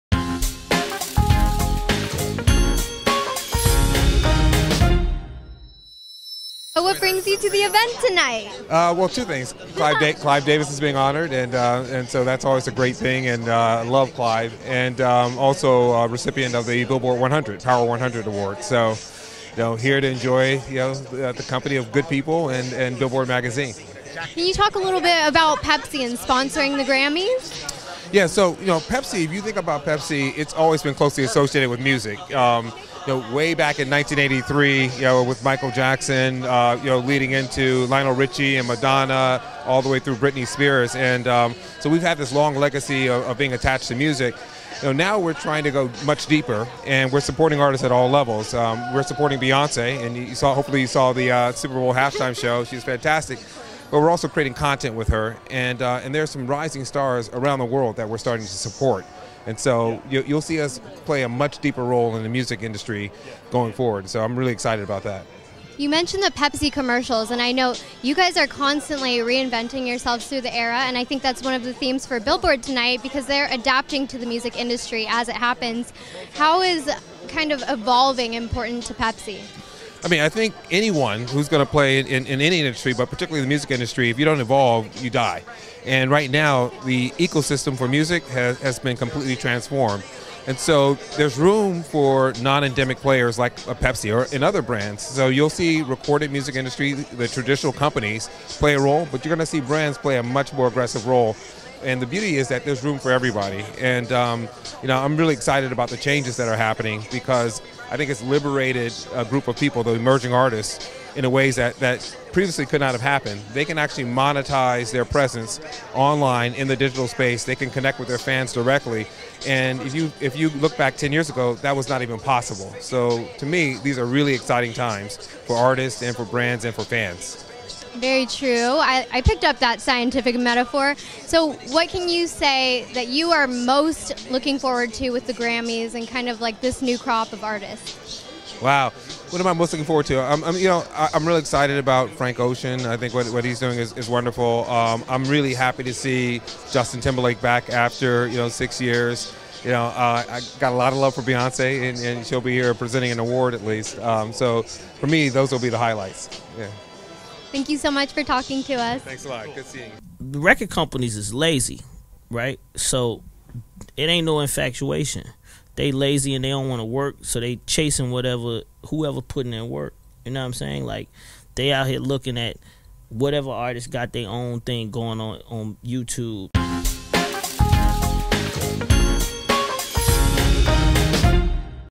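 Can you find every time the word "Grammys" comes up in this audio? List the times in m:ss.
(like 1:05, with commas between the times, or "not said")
0:26, 2:15.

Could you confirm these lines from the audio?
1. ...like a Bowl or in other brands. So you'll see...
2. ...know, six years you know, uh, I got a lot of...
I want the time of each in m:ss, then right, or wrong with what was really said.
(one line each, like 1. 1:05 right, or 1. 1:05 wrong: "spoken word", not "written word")
1. 1:33 wrong: "Pepsi", not "Bowl"
2. 2:28 right.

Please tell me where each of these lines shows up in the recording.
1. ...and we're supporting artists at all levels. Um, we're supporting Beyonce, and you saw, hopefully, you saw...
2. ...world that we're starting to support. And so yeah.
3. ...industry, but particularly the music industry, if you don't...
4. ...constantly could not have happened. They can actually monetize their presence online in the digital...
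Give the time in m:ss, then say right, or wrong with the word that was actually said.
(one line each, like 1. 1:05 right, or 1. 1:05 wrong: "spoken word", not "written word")
1. 0:46 right
2. 0:57 right
3. 1:22 right
4. 1:52 wrong: "previously", not "constantly".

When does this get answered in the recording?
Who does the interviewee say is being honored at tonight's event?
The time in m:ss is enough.
0:10.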